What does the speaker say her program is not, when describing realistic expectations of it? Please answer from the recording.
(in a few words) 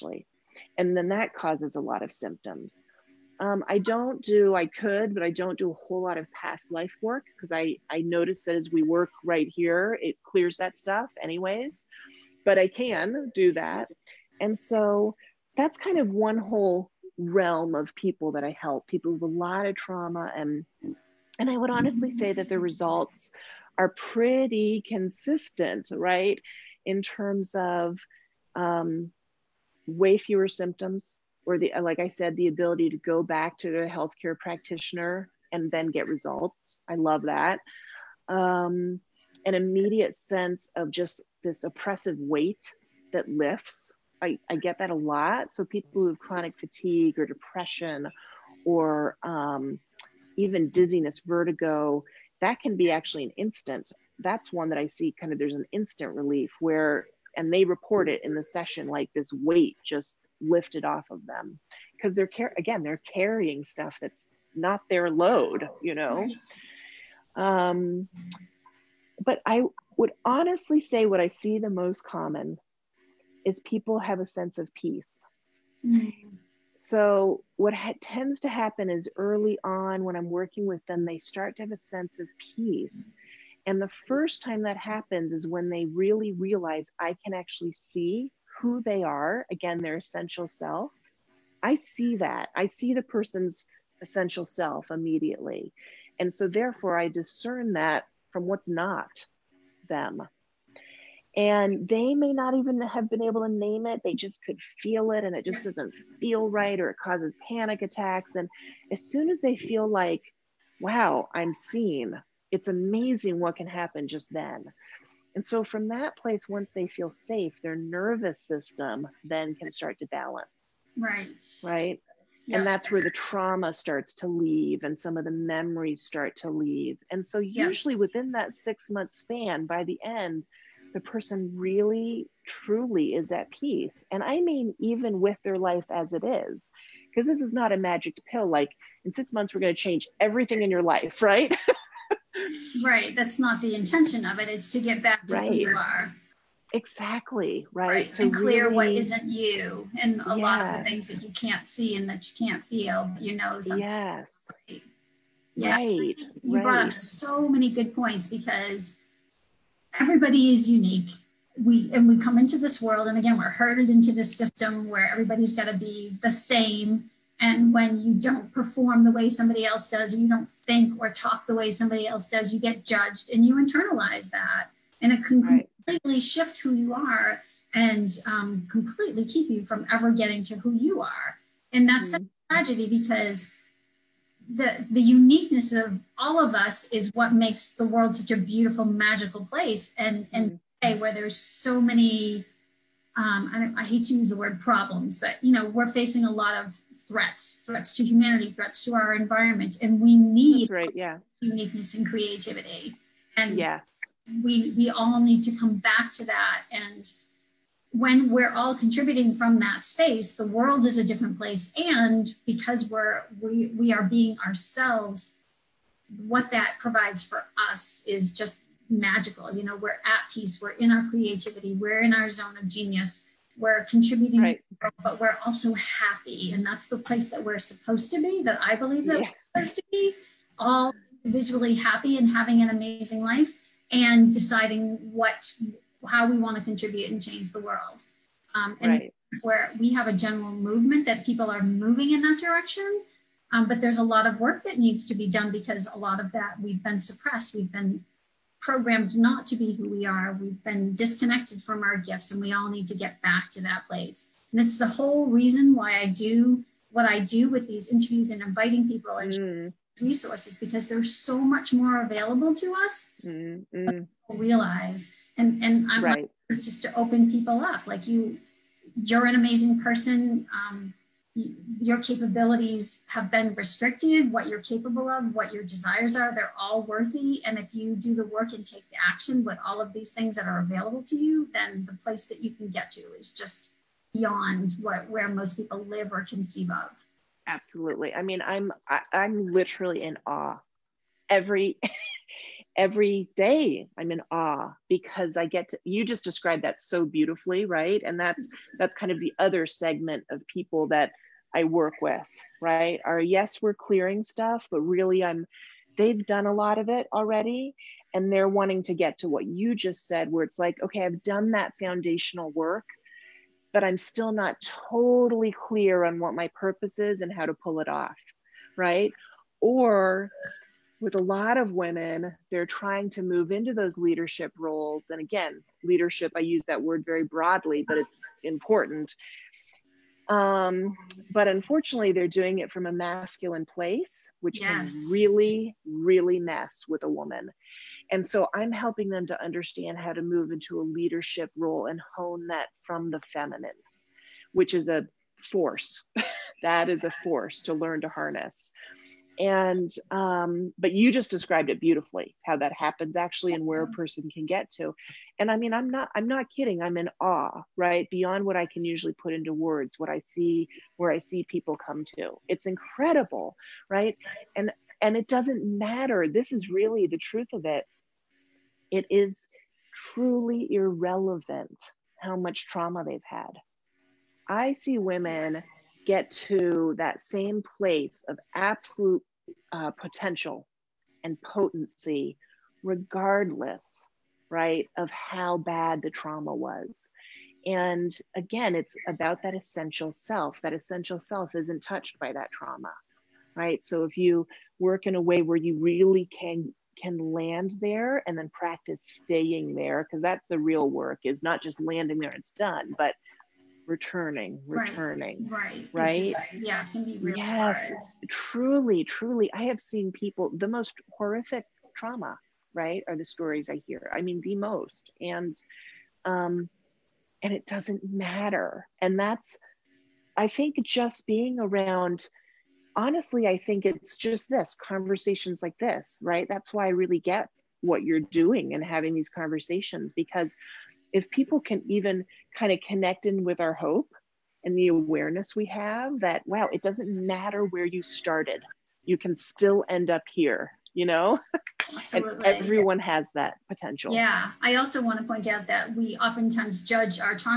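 a magic pill.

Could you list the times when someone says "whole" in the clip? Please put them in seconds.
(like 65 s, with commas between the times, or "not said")
5 s, 16 s, 254 s.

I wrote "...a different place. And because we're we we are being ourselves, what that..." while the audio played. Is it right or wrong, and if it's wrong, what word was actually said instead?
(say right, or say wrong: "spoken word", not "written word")
right.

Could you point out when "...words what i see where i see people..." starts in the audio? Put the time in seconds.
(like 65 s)
359 s.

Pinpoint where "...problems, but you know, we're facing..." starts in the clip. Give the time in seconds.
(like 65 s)
194 s.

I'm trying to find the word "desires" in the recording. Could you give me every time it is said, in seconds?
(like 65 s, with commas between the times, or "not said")
275 s.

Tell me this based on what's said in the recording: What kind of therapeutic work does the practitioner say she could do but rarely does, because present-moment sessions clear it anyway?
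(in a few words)
past life work.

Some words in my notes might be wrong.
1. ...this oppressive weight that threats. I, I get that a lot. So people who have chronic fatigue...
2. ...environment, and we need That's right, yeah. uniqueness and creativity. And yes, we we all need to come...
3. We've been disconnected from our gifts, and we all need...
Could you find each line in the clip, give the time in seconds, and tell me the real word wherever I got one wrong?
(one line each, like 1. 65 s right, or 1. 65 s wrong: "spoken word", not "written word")
1. 41 s wrong: "lifts", not "threats"
2. 199 s right
3. 250 s right.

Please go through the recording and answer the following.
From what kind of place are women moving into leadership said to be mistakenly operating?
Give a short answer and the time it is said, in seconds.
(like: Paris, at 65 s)
masculine, at 332 s.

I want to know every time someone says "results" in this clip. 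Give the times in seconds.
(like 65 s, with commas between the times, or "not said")
22 s, 36 s.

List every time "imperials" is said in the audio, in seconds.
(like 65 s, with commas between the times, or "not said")
not said.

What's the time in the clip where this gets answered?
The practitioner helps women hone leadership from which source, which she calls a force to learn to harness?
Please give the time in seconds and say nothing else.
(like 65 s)
343 s.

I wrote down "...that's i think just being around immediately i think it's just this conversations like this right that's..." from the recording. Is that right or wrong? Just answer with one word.
wrong.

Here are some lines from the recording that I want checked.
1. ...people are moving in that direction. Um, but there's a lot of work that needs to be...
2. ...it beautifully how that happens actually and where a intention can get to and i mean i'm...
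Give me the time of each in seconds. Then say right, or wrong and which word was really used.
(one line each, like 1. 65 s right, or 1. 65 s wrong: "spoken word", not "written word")
1. 241 s right
2. 351 s wrong: "person", not "intention".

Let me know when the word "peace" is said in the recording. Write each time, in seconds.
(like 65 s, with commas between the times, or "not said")
74 s, 82 s, 133 s, 220 s.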